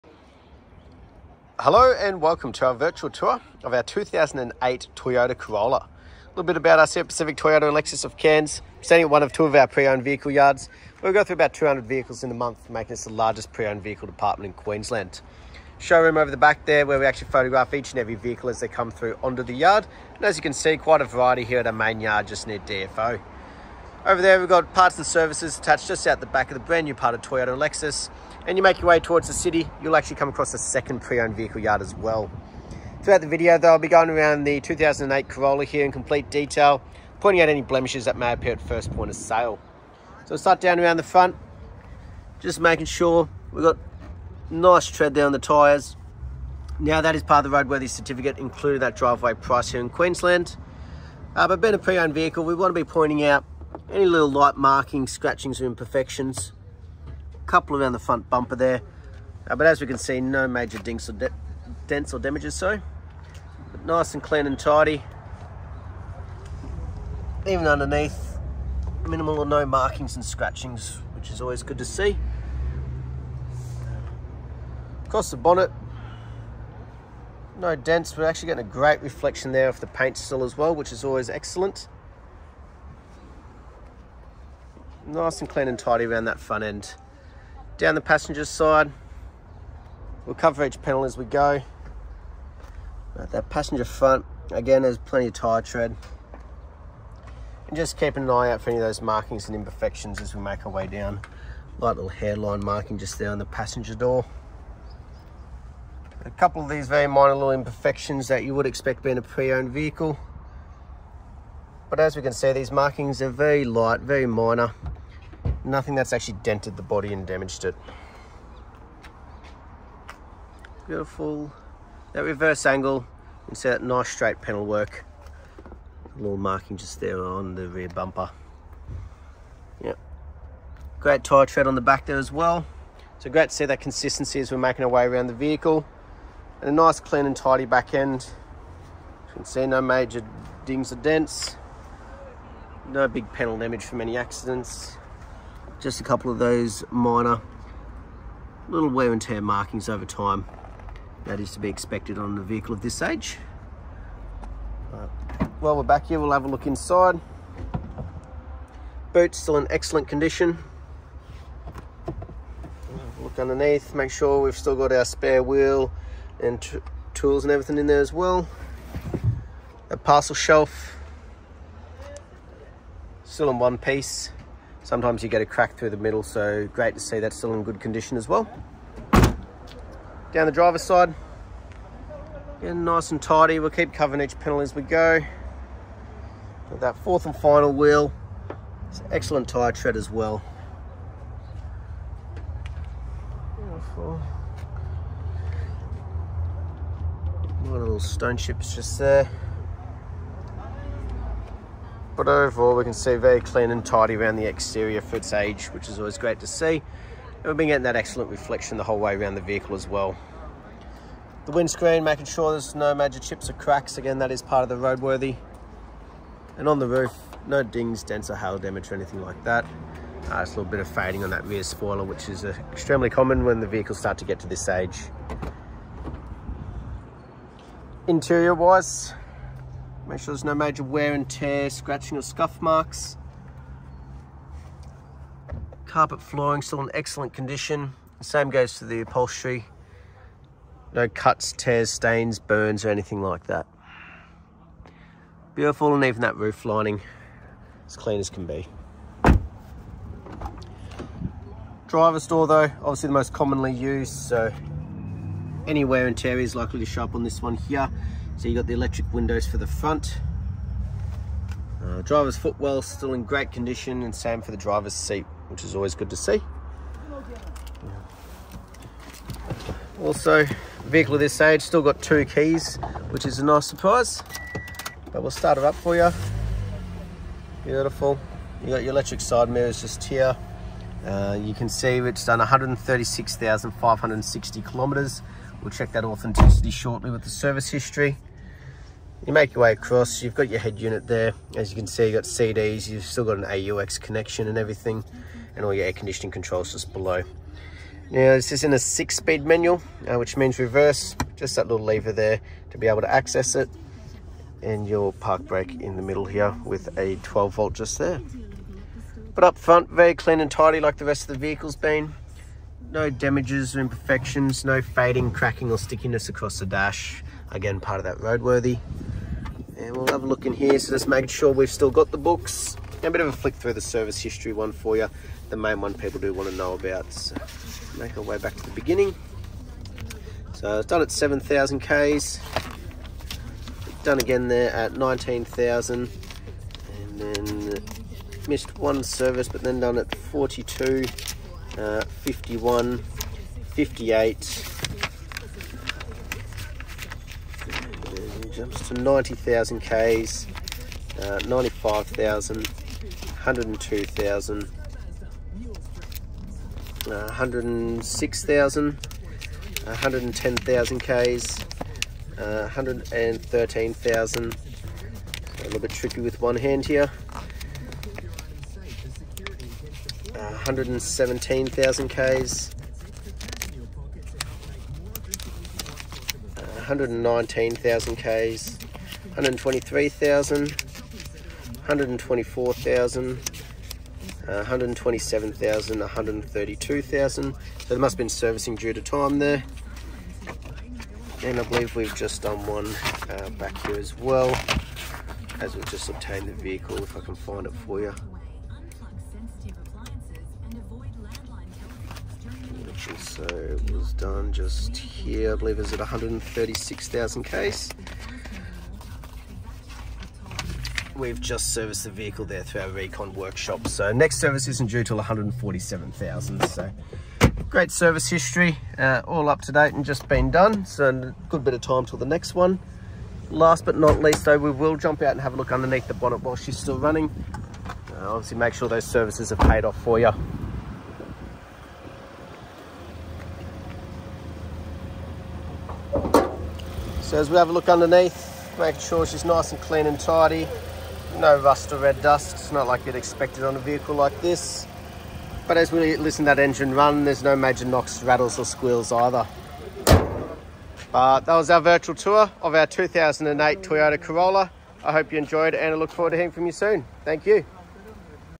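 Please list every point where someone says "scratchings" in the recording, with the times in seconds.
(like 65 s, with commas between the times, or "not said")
55 s, 70 s, 231 s.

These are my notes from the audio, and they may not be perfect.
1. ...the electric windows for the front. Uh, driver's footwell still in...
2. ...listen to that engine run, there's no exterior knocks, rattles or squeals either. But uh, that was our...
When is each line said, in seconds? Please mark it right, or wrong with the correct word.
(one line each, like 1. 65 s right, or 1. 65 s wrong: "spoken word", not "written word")
1. 258 s right
2. 446 s wrong: "major", not "exterior".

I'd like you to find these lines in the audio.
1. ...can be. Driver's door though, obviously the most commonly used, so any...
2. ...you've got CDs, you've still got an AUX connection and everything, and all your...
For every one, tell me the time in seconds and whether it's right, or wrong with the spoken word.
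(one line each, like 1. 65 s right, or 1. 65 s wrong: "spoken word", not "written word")
1. 248 s right
2. 292 s right.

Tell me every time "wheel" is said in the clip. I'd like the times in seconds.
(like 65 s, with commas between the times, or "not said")
165 s, 187 s.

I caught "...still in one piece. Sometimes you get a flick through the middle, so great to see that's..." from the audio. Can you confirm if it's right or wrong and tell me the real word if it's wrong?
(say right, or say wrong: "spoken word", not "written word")
wrong: "crack", not "flick".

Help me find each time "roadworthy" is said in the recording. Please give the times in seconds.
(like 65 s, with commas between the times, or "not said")
47 s, 214 s, 318 s.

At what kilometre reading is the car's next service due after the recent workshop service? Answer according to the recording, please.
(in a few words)
147,000.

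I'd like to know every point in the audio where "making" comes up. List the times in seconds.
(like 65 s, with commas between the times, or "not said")
12 s, 42 s, 134 s, 212 s, 321 s, 438 s.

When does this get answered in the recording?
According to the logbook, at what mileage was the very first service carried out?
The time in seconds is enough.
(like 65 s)
331 s.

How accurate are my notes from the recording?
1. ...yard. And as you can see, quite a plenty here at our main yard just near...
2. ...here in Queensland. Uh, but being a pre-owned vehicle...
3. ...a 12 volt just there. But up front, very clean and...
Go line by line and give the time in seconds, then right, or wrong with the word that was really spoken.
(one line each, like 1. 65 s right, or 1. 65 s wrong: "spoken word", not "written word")
1. 19 s wrong: "variety", not "plenty"
2. 49 s right
3. 306 s right.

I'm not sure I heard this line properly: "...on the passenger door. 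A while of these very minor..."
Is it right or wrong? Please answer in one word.
wrong.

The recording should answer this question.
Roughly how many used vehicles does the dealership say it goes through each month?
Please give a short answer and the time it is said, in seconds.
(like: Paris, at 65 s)
200, at 11 s.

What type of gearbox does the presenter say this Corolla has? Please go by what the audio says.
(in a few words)
Six-speed manual.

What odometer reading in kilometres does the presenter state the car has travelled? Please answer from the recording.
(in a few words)
136,560.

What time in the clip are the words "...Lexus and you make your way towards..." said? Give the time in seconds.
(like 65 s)
27 s.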